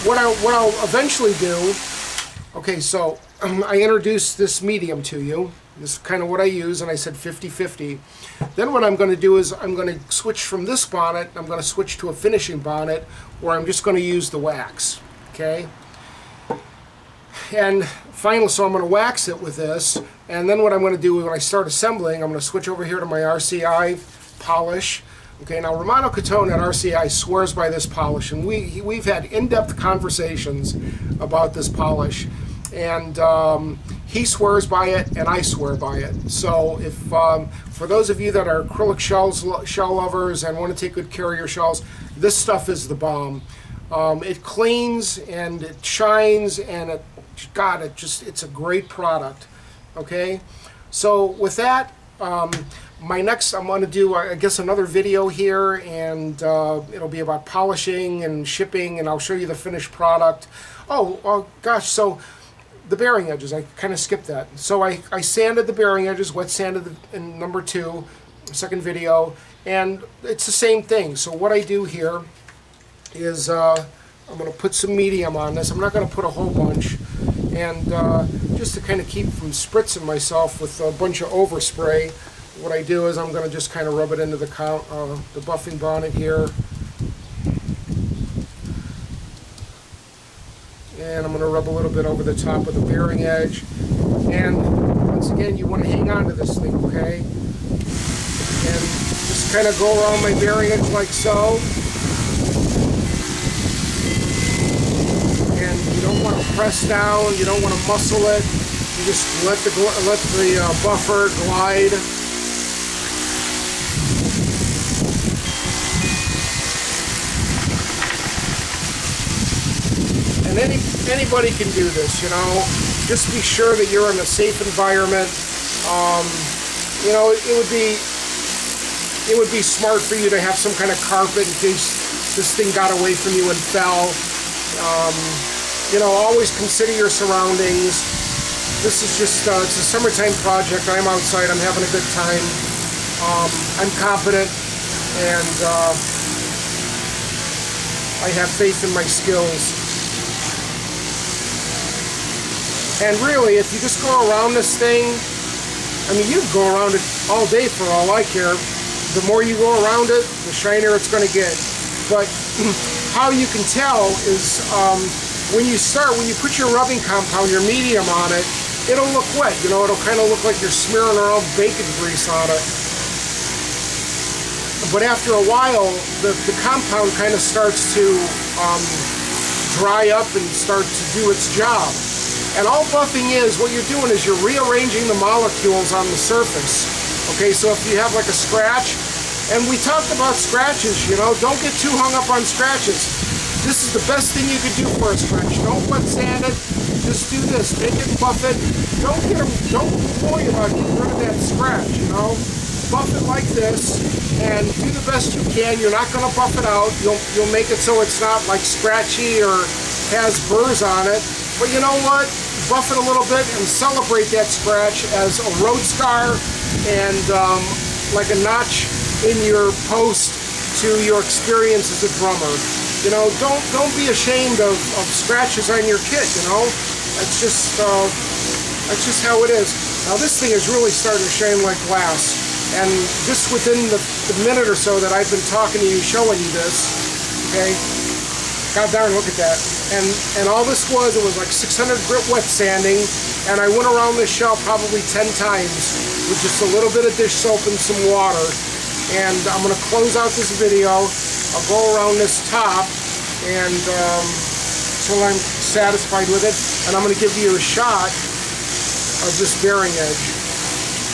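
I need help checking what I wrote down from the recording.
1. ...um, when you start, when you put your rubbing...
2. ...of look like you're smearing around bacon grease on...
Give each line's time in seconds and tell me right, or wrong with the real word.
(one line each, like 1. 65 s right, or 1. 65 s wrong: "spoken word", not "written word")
1. 164 s right
2. 170 s right.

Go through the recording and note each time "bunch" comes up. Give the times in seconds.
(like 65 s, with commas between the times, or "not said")
76 s, 80 s.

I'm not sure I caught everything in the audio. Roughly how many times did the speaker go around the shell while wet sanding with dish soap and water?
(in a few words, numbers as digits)
10.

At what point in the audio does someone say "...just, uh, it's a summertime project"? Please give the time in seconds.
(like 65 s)
139 s.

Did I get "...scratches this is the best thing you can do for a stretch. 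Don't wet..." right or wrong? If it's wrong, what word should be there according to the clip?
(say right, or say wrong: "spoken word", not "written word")
right.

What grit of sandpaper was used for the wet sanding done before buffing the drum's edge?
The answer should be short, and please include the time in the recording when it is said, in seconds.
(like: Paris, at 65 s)
600, at 241 s.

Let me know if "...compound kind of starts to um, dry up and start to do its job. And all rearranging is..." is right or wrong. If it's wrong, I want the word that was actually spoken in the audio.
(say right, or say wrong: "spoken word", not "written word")
wrong: "buffing", not "rearranging".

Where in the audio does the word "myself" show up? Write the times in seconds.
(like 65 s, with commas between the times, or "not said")
80 s.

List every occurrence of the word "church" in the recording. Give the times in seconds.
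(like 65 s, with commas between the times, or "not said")
not said.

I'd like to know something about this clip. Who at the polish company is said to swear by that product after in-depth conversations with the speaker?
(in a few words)
Romano Catone.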